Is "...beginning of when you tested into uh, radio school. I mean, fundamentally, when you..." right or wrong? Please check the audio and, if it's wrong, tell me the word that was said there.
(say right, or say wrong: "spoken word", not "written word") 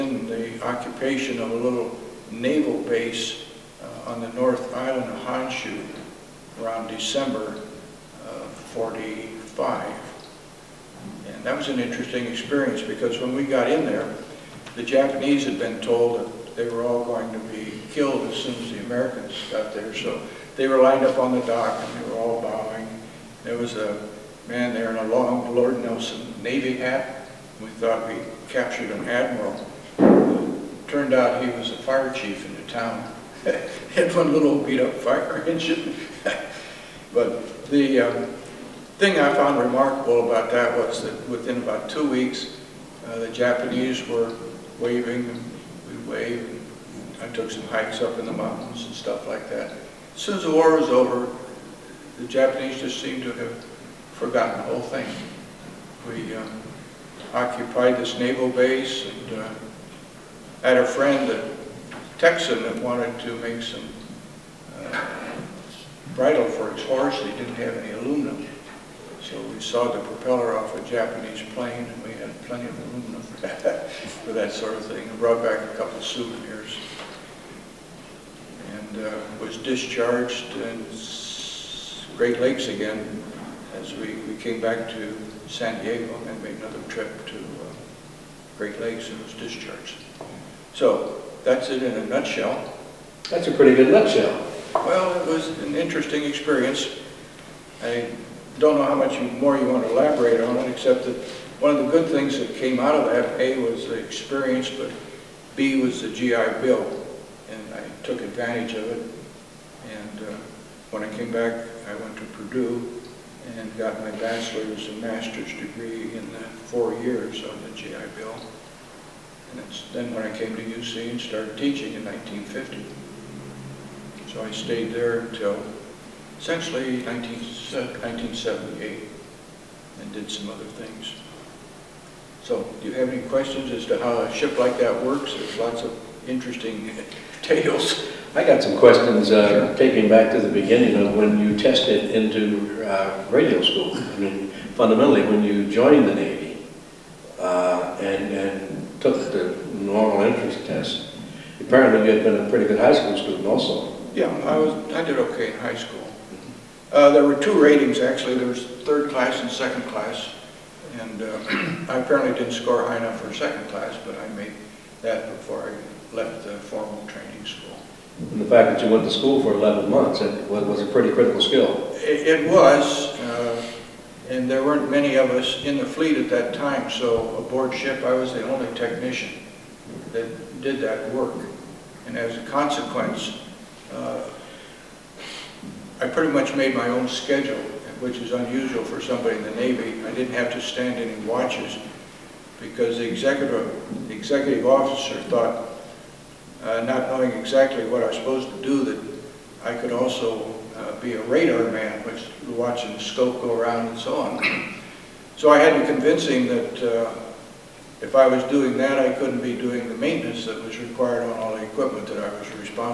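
right.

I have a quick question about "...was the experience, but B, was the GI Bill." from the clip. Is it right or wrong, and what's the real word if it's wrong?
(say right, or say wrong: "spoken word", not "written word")
right.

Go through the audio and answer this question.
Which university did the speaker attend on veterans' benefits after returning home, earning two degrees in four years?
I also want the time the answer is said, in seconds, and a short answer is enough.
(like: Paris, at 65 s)
Purdue, at 112 s.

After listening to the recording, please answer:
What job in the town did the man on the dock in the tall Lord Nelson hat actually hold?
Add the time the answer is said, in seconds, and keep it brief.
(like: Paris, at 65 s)
fire chief, at 31 s.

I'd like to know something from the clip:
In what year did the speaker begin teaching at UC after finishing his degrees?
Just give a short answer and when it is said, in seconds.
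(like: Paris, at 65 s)
1950, at 122 s.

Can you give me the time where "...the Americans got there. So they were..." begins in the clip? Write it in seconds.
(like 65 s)
18 s.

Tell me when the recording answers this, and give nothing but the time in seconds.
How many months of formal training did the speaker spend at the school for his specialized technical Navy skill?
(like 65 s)
169 s.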